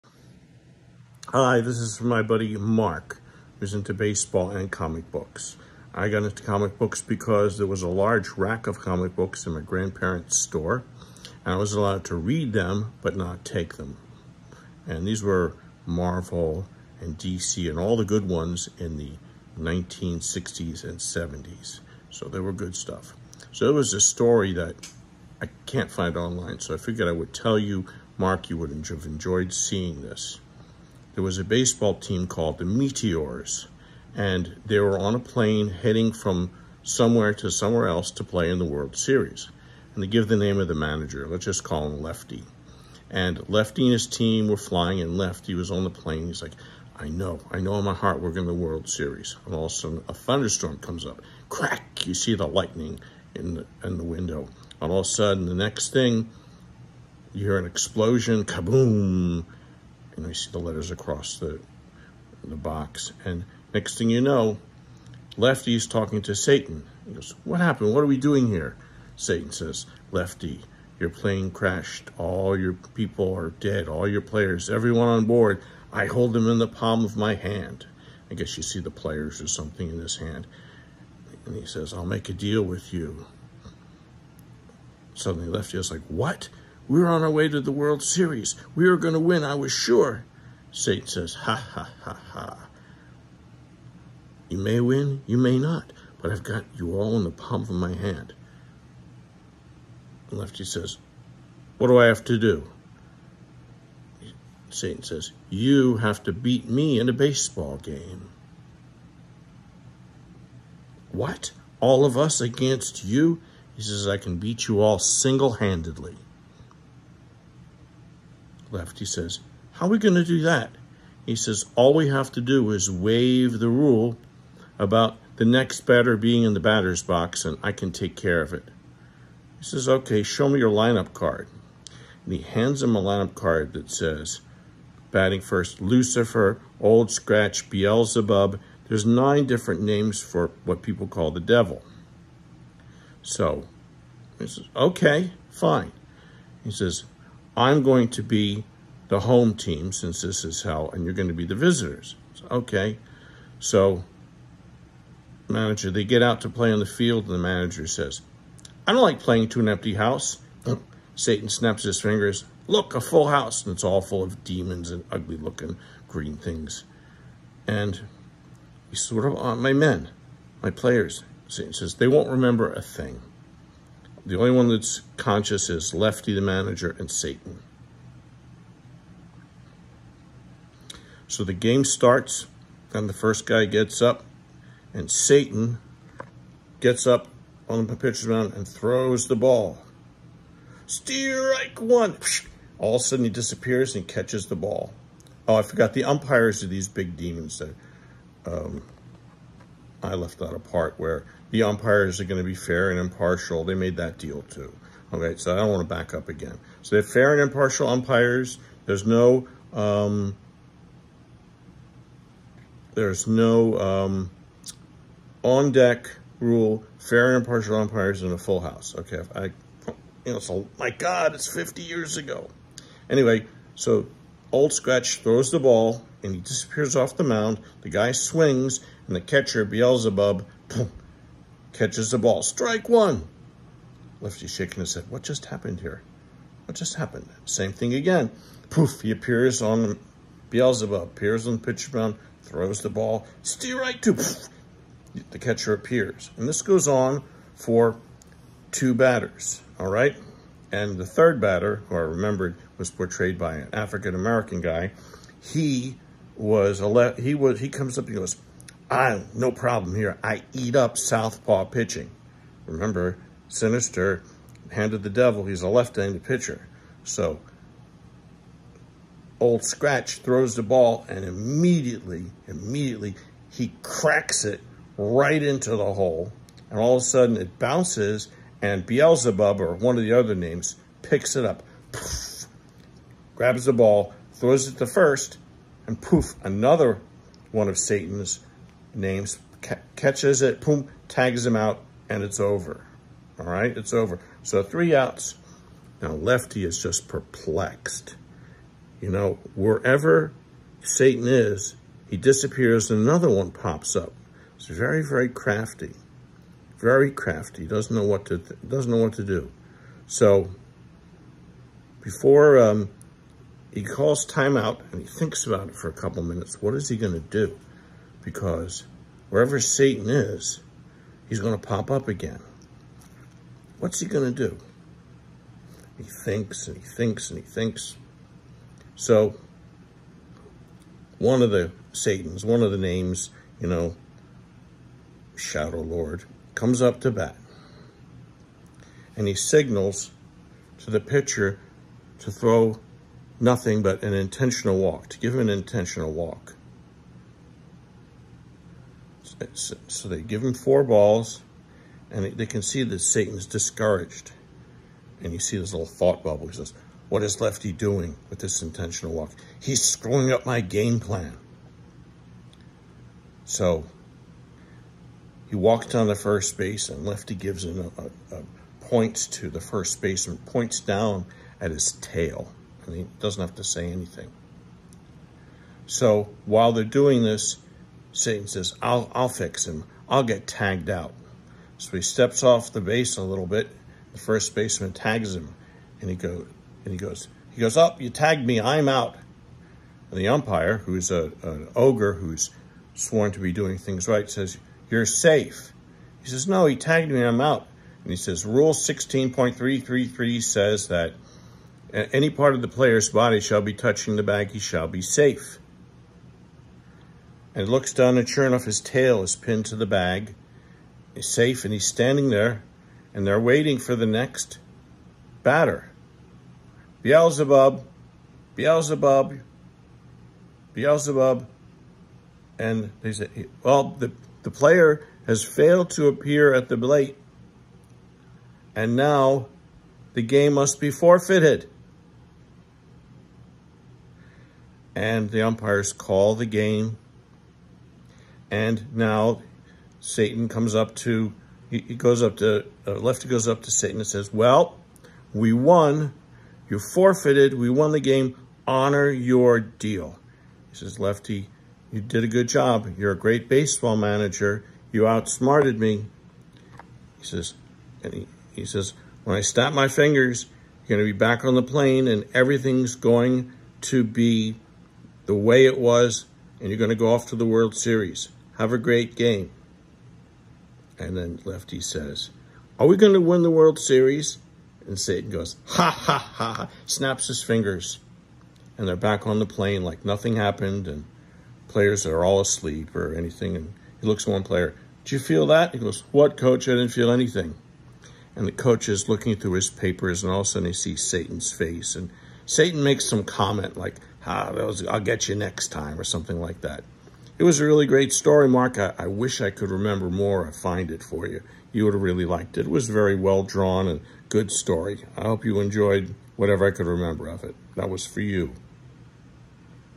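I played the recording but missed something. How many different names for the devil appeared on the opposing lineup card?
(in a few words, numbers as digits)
9.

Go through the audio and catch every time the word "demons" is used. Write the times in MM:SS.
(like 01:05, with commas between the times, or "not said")
02:44, 03:17.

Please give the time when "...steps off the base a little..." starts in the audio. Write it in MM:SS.
06:22.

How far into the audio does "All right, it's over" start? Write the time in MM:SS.
04:53.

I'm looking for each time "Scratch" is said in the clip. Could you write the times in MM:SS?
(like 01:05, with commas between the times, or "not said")
02:17, 03:44, 04:29.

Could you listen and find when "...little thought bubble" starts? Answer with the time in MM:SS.
05:55.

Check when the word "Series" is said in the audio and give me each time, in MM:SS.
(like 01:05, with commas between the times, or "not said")
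00:38, 00:48, 01:28, 07:47, 07:53.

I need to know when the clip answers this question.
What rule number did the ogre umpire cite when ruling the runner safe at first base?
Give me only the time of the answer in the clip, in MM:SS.
06:38.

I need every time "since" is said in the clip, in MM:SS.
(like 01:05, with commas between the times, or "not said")
02:29.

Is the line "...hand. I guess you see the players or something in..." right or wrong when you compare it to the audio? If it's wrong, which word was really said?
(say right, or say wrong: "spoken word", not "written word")
right.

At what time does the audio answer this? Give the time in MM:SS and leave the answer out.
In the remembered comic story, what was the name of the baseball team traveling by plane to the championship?
00:31.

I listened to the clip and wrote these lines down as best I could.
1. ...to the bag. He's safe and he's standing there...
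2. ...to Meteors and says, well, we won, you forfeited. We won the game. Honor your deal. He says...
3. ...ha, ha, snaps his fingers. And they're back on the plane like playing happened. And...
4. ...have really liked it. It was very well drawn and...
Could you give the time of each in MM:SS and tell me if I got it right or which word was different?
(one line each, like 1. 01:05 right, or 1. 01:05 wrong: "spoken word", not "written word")
1. 06:49 right
2. 07:23 wrong: "Satan", not "Meteors"
3. 07:55 wrong: "nothing", not "playing"
4. 08:21 right.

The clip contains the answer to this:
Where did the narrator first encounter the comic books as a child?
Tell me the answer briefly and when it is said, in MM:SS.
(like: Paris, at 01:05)
grandparents' store, at 00:09.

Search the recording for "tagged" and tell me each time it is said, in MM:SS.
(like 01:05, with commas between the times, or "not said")
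06:20, 06:28, 06:36.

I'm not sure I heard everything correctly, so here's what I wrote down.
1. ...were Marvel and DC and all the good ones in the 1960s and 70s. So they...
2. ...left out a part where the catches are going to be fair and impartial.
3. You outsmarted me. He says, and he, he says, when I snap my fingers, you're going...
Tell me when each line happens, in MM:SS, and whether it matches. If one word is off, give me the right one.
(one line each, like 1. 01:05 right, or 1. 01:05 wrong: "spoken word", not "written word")
1. 00:15 right
2. 03:20 wrong: "umpires", not "catches"
3. 07:34 right.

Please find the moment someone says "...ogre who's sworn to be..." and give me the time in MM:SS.
06:31.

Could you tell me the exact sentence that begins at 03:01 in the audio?
So the game starts, and the first guy gets up, and Satan gets up on the pitcher's mound and throws the ball.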